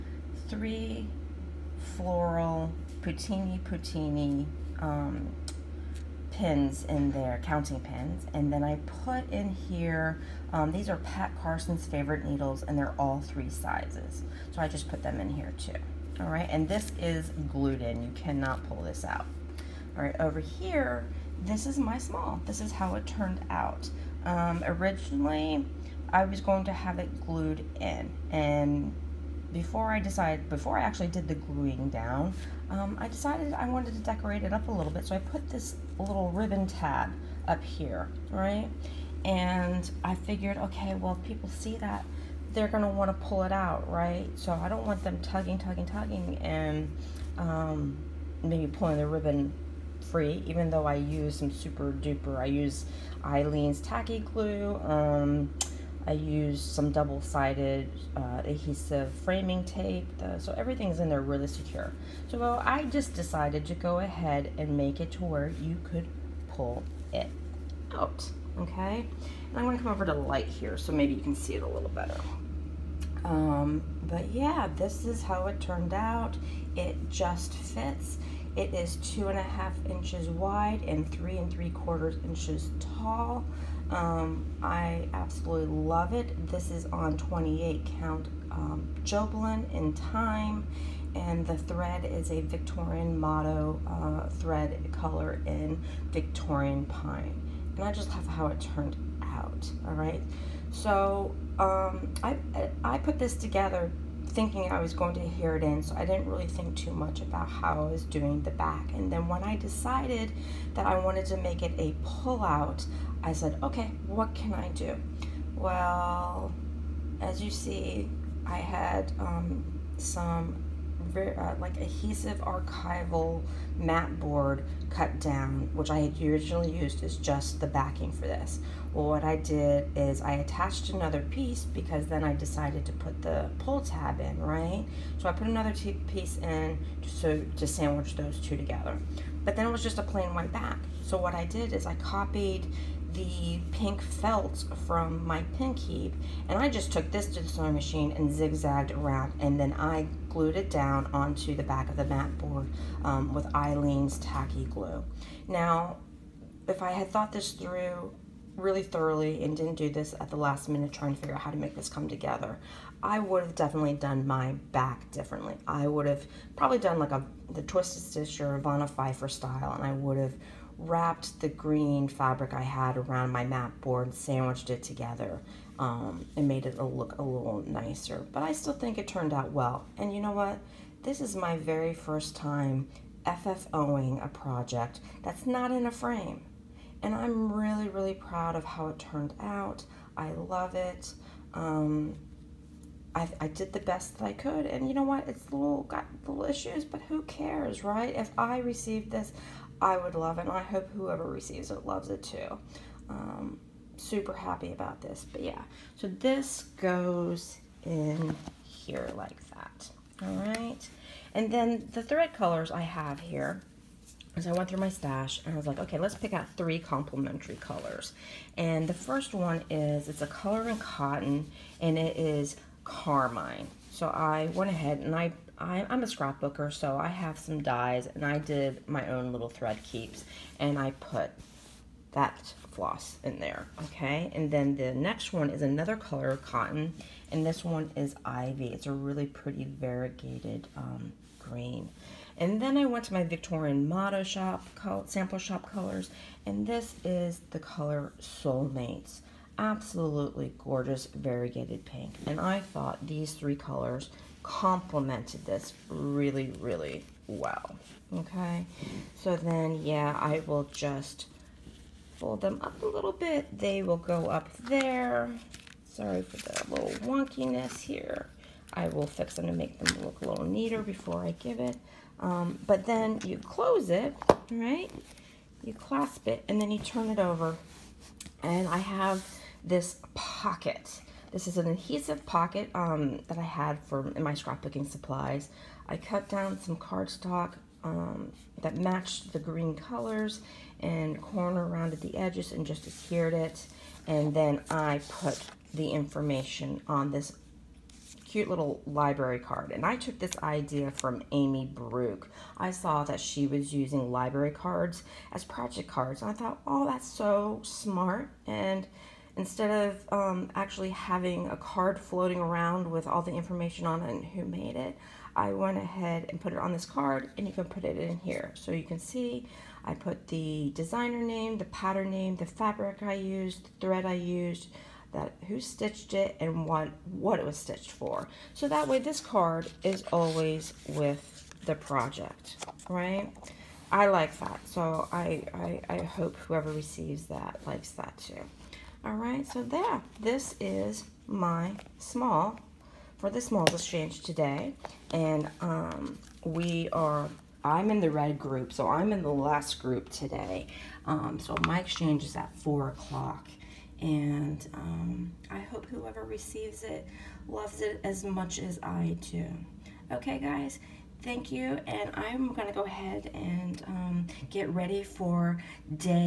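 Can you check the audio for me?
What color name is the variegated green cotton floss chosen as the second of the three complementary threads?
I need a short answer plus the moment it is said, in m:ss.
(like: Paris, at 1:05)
Ivy, at 3:58.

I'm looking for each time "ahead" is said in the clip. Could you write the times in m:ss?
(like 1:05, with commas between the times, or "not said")
1:03, 3:44, 5:15, 6:02.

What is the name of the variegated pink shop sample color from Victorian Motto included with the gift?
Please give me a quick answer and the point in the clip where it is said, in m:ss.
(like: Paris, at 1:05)
Soulmates, at 4:08.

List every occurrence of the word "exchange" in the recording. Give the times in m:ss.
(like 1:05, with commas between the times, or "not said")
5:43, 5:51.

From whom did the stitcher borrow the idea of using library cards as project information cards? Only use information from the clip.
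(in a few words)
Amy Brook.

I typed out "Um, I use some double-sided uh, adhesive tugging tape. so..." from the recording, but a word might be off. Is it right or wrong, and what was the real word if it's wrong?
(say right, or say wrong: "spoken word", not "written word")
wrong: "framing", not "tugging".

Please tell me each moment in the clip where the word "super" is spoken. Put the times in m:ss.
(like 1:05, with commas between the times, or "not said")
0:51, 3:24.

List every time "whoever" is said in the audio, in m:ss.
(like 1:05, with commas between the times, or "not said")
3:20, 5:36, 5:55.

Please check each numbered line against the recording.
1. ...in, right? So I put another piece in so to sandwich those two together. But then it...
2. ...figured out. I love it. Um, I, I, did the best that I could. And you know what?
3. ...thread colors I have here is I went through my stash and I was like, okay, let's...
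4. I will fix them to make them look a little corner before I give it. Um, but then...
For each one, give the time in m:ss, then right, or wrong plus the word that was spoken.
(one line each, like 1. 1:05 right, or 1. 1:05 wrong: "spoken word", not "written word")
1. 2:14 right
2. 3:08 wrong: "turned", not "figured"
3. 3:32 right
4. 4:28 wrong: "neater", not "corner".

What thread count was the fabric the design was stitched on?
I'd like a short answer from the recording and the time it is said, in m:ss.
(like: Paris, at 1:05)
28 count, at 1:27.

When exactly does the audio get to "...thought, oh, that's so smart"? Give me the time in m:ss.
5:06.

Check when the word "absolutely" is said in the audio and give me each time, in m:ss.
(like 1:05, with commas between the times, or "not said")
1:25, 4:09.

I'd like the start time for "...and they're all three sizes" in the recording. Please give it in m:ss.
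0:12.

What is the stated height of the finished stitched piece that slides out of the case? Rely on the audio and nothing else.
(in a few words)
3 3/4 inches.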